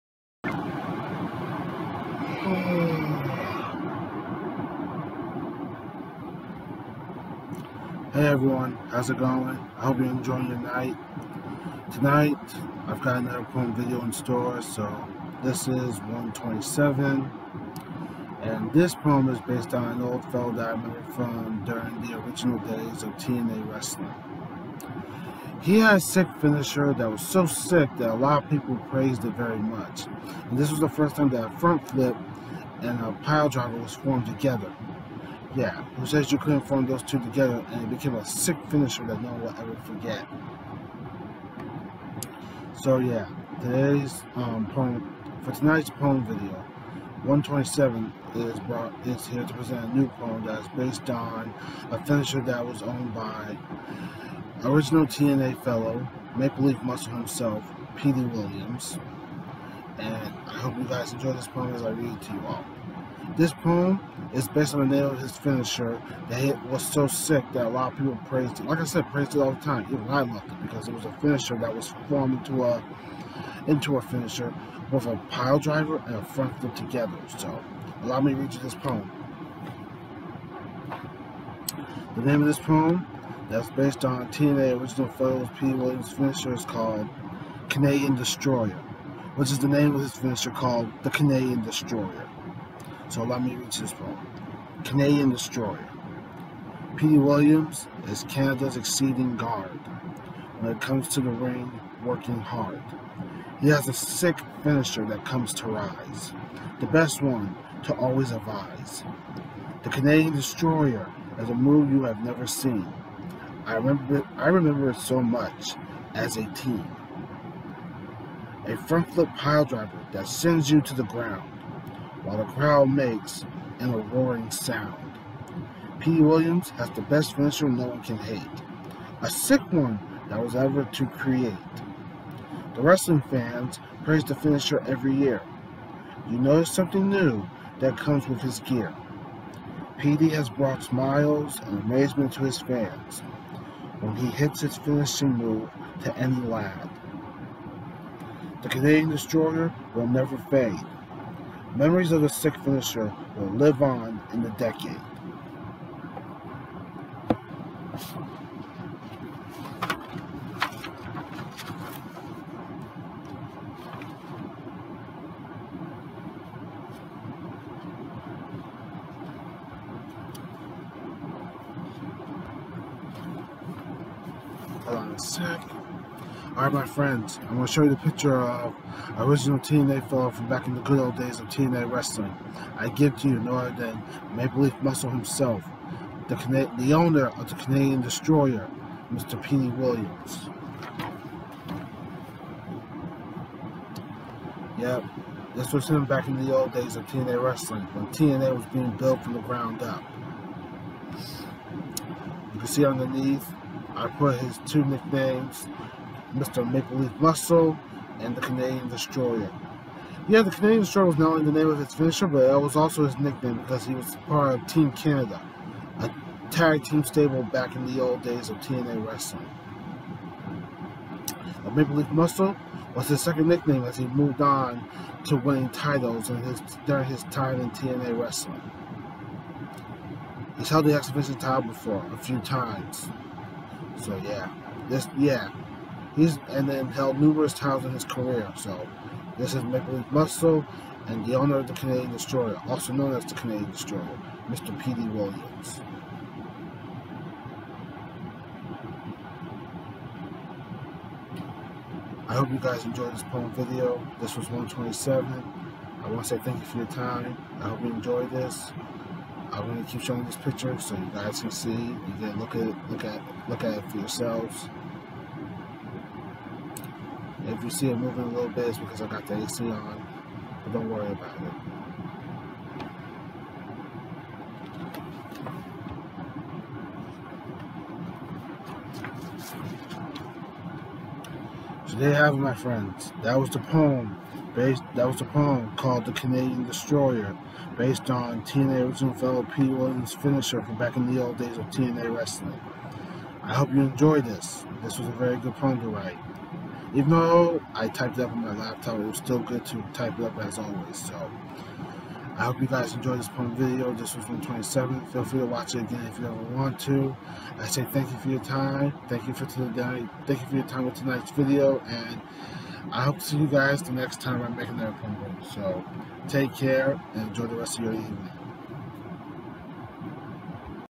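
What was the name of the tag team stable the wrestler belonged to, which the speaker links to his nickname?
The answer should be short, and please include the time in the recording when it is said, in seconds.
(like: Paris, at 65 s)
Team Canada, at 214 s.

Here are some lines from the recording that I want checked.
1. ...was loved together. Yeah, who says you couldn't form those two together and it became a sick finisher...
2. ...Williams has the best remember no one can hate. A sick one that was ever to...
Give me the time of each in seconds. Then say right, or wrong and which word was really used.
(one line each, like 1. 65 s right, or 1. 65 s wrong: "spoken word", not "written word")
1. 33 s wrong: "formed", not "loved"
2. 126 s wrong: "finisher", not "remember".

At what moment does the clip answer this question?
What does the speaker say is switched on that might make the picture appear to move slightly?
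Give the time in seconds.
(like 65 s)
269 s.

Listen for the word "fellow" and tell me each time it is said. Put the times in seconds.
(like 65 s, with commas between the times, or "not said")
20 s, 55 s, 180 s, 289 s.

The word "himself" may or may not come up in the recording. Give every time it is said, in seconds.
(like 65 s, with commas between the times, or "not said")
57 s, 185 s.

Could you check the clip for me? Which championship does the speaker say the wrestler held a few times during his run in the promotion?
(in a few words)
X Division title.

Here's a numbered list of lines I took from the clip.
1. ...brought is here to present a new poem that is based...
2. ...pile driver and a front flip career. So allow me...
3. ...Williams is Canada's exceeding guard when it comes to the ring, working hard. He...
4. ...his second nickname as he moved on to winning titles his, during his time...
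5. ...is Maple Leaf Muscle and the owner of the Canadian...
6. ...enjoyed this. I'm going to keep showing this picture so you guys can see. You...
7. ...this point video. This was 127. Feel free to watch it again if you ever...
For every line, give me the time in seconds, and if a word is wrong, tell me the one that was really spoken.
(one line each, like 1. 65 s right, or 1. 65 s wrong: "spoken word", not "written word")
1. 48 s right
2. 75 s wrong: "together", not "career"
3. 97 s right
4. 223 s right
5. 239 s right
6. 257 s right
7. 303 s right.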